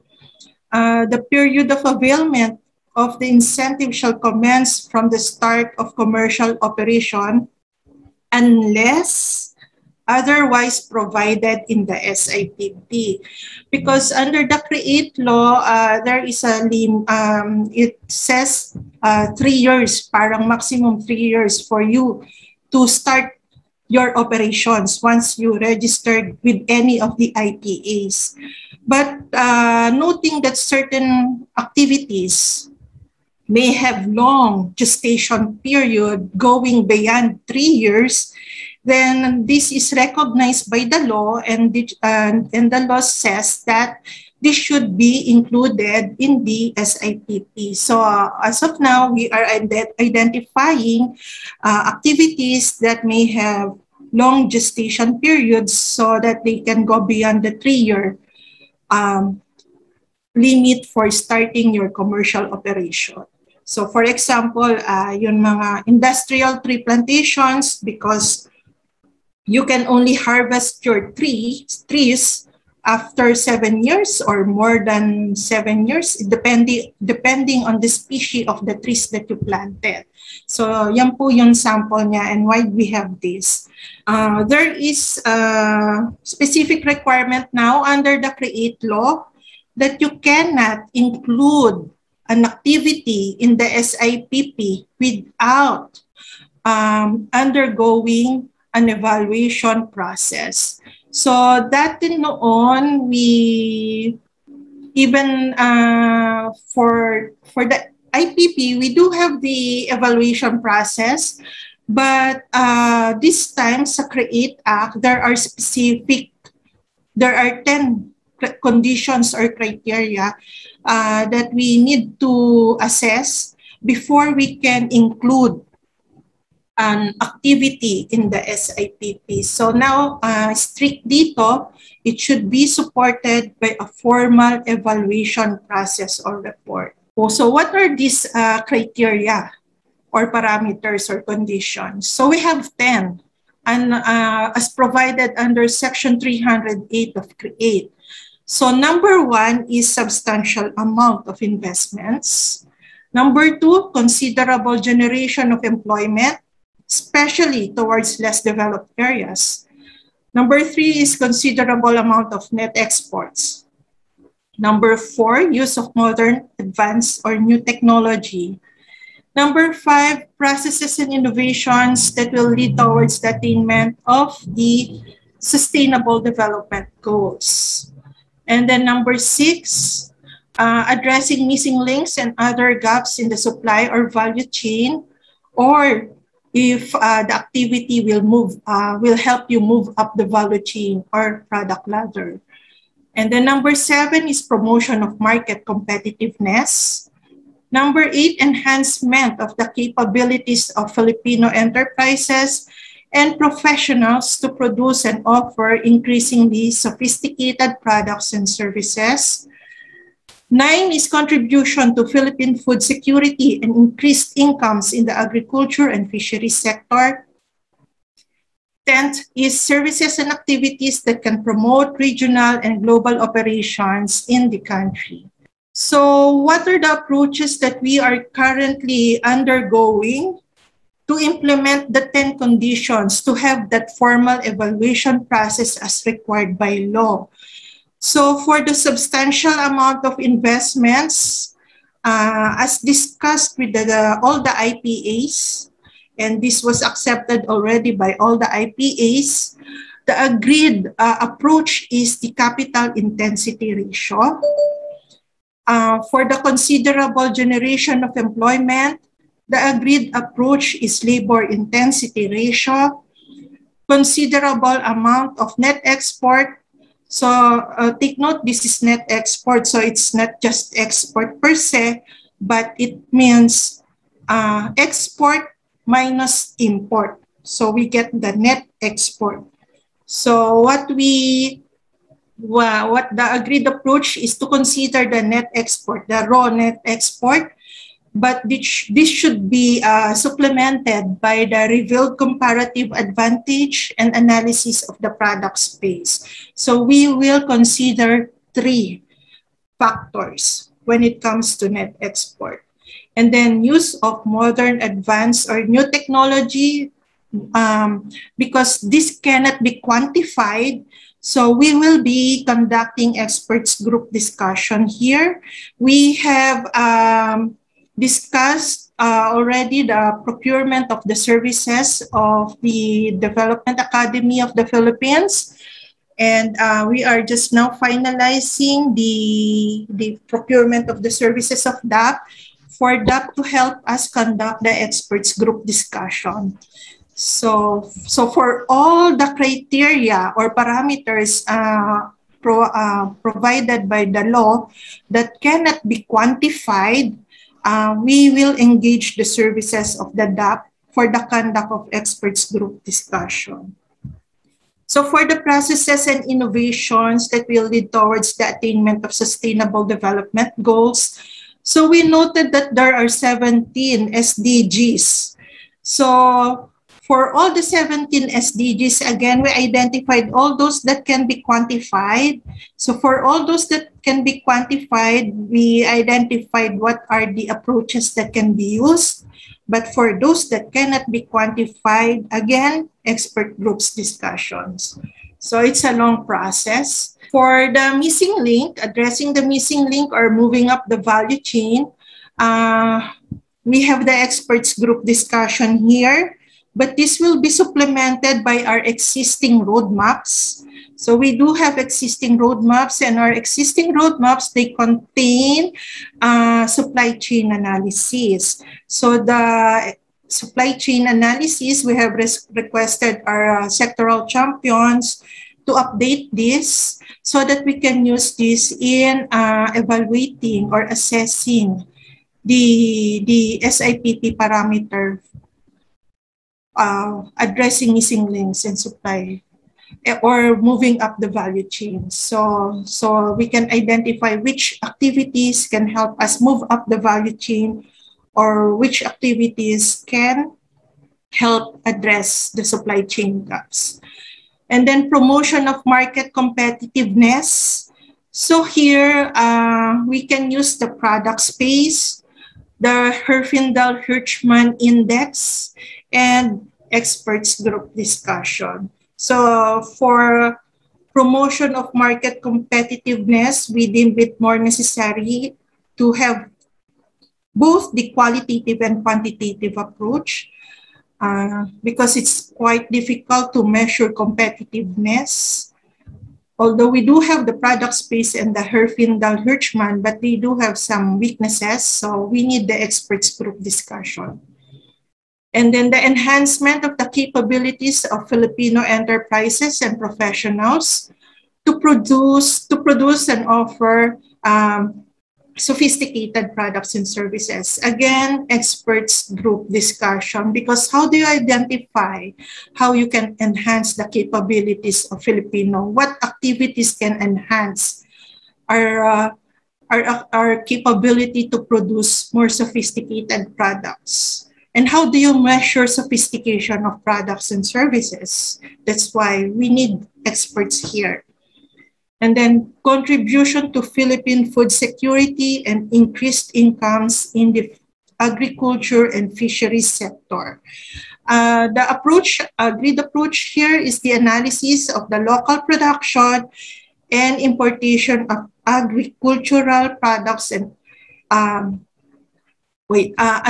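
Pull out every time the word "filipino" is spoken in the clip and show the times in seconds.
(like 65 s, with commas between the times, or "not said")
200 s, 488 s, 505 s.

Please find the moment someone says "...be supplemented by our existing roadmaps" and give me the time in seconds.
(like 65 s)
397 s.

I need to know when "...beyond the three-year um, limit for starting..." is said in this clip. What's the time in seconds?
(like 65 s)
57 s.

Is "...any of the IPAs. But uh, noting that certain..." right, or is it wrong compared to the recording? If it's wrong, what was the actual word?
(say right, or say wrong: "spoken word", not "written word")
right.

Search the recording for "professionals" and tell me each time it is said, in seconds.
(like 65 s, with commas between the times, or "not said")
203 s, 489 s.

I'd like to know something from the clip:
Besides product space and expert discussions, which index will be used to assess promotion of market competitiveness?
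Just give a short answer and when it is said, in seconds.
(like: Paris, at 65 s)
Herfindahl-Hirschman index, at 453 s.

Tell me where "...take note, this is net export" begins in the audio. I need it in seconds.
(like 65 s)
267 s.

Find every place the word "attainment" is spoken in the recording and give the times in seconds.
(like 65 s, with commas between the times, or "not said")
173 s, 358 s.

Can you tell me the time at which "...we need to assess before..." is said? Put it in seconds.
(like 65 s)
121 s.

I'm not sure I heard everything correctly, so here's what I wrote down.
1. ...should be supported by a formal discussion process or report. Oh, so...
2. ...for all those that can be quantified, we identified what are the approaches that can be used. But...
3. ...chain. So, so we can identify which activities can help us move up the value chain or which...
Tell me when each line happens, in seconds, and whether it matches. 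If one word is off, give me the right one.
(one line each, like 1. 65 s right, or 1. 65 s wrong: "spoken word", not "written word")
1. 132 s wrong: "evaluation", not "discussion"
2. 373 s right
3. 431 s right.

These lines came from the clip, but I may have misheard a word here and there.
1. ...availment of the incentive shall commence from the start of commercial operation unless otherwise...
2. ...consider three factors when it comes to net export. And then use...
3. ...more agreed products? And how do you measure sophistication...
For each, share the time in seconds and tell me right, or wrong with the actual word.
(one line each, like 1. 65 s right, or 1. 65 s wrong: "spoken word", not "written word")
1. 1 s right
2. 297 s right
3. 512 s wrong: "sophisticated", not "agreed".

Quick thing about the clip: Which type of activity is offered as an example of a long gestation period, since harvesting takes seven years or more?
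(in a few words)
Industrial tree plantations.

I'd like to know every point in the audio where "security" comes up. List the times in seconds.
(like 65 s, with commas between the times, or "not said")
212 s, 524 s.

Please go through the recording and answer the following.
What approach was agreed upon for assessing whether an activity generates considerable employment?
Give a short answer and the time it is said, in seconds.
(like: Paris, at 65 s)
Labor intensity ratio, at 261 s.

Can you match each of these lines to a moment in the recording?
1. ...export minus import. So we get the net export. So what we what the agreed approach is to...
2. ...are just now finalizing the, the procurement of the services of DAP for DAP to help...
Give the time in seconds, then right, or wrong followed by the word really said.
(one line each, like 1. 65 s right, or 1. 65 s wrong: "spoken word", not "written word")
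1. 274 s right
2. 327 s right.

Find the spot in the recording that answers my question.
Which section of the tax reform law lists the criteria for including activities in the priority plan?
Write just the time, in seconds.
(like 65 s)
145 s.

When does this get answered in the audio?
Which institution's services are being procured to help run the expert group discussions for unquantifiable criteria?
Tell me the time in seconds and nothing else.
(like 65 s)
323 s.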